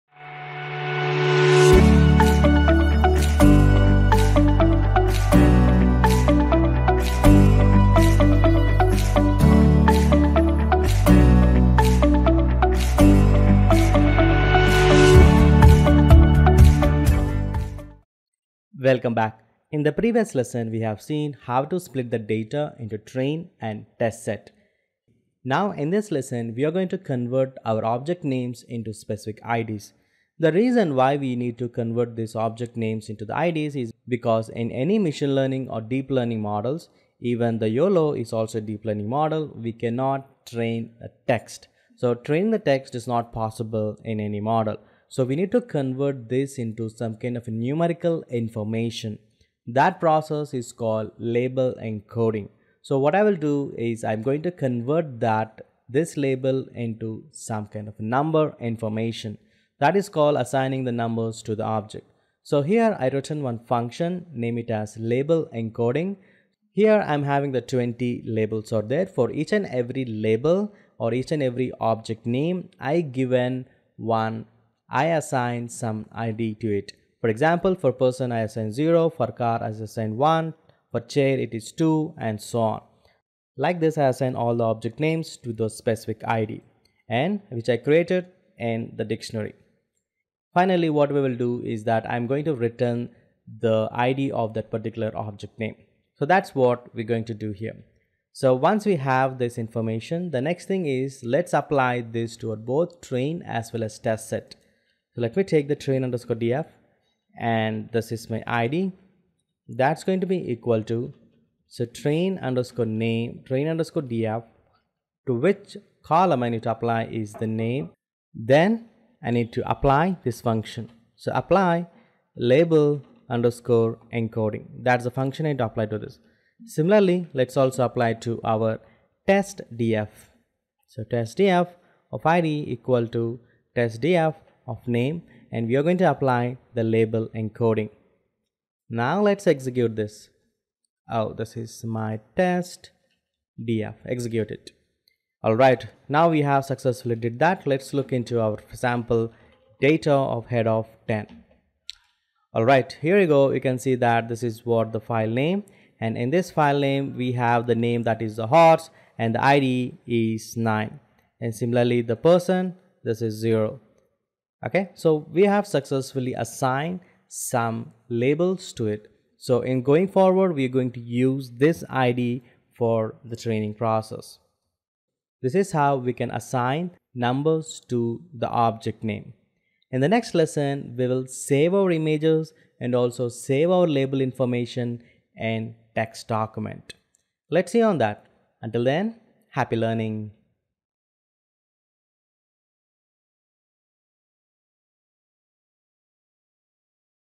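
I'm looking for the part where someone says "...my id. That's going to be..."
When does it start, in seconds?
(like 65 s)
108 s.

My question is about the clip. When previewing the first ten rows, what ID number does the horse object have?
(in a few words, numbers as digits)
9.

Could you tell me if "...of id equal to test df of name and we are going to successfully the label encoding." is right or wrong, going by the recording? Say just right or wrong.
wrong.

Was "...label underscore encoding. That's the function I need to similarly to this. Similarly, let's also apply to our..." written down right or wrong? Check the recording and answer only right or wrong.
wrong.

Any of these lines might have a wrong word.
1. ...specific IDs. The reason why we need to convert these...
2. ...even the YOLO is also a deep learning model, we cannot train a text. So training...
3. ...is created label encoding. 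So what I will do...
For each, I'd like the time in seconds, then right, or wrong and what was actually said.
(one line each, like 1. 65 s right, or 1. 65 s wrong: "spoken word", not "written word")
1. 28 s right
2. 37 s right
3. 50 s wrong: "called", not "created".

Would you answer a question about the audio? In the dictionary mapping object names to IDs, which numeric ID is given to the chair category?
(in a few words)
2.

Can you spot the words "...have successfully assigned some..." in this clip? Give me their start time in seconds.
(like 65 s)
165 s.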